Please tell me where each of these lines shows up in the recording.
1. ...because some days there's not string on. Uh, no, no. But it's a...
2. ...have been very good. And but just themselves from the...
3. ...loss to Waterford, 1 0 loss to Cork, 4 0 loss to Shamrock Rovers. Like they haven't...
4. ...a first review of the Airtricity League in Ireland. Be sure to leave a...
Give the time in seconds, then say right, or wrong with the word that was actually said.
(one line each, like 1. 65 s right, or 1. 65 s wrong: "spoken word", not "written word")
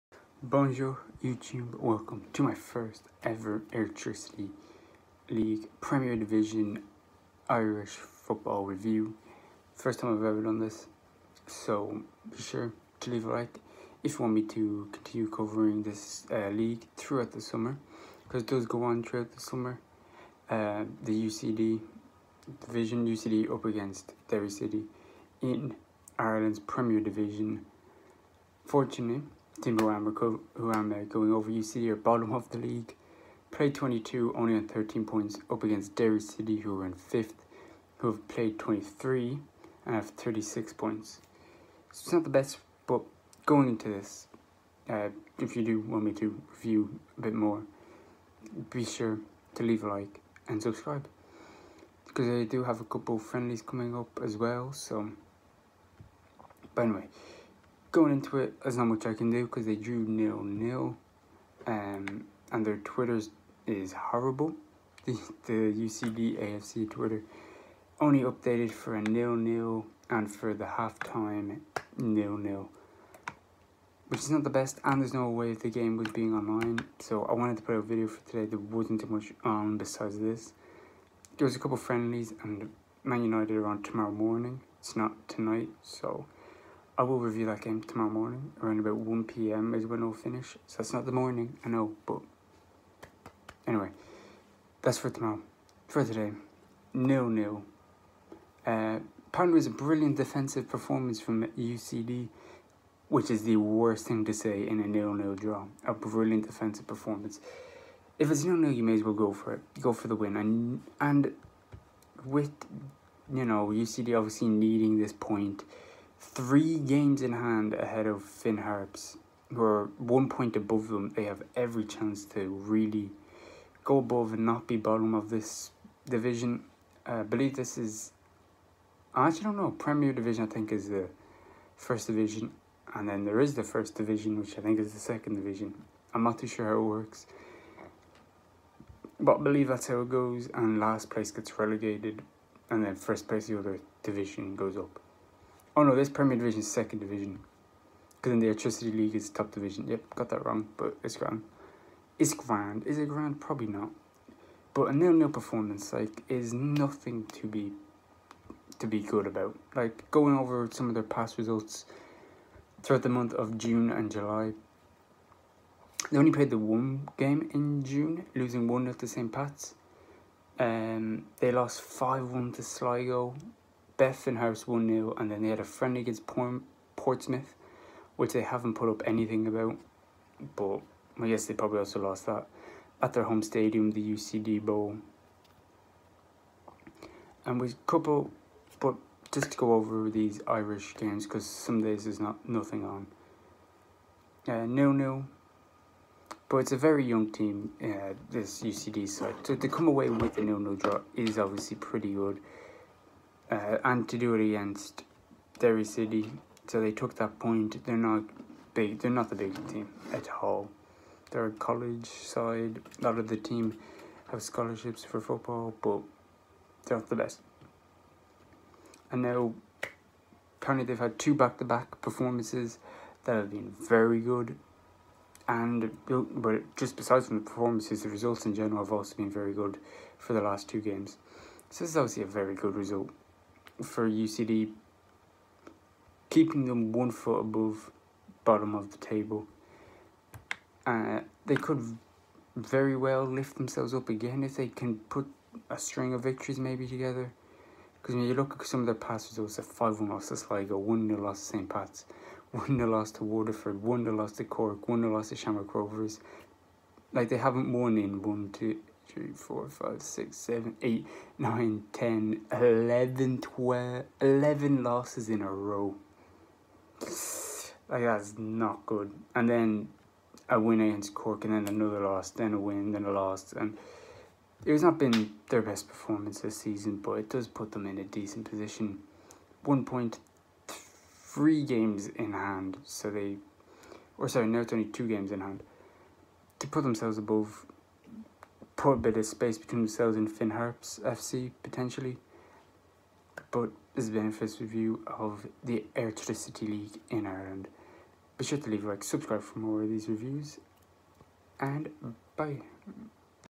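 1. 191 s wrong: "nothing", not "string"
2. 223 s wrong: "besides", not "themselves"
3. 252 s wrong: "1", not "4"
4. 294 s right.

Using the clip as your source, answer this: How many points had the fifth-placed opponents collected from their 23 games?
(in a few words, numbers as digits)
36.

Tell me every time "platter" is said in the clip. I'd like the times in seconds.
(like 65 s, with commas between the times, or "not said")
not said.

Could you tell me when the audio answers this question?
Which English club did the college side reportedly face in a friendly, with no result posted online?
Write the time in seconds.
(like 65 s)
176 s.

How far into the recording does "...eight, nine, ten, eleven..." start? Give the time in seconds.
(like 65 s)
260 s.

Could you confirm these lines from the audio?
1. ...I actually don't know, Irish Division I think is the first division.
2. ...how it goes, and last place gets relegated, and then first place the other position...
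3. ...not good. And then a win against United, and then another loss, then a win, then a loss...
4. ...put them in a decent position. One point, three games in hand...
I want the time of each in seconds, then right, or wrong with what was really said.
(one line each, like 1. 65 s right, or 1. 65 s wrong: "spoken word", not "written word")
1. 129 s wrong: "Premier", not "Irish"
2. 139 s wrong: "division", not "position"
3. 268 s wrong: "Cork", not "United"
4. 277 s right.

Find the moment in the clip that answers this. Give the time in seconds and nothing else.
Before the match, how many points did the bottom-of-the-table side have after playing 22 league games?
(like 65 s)
34 s.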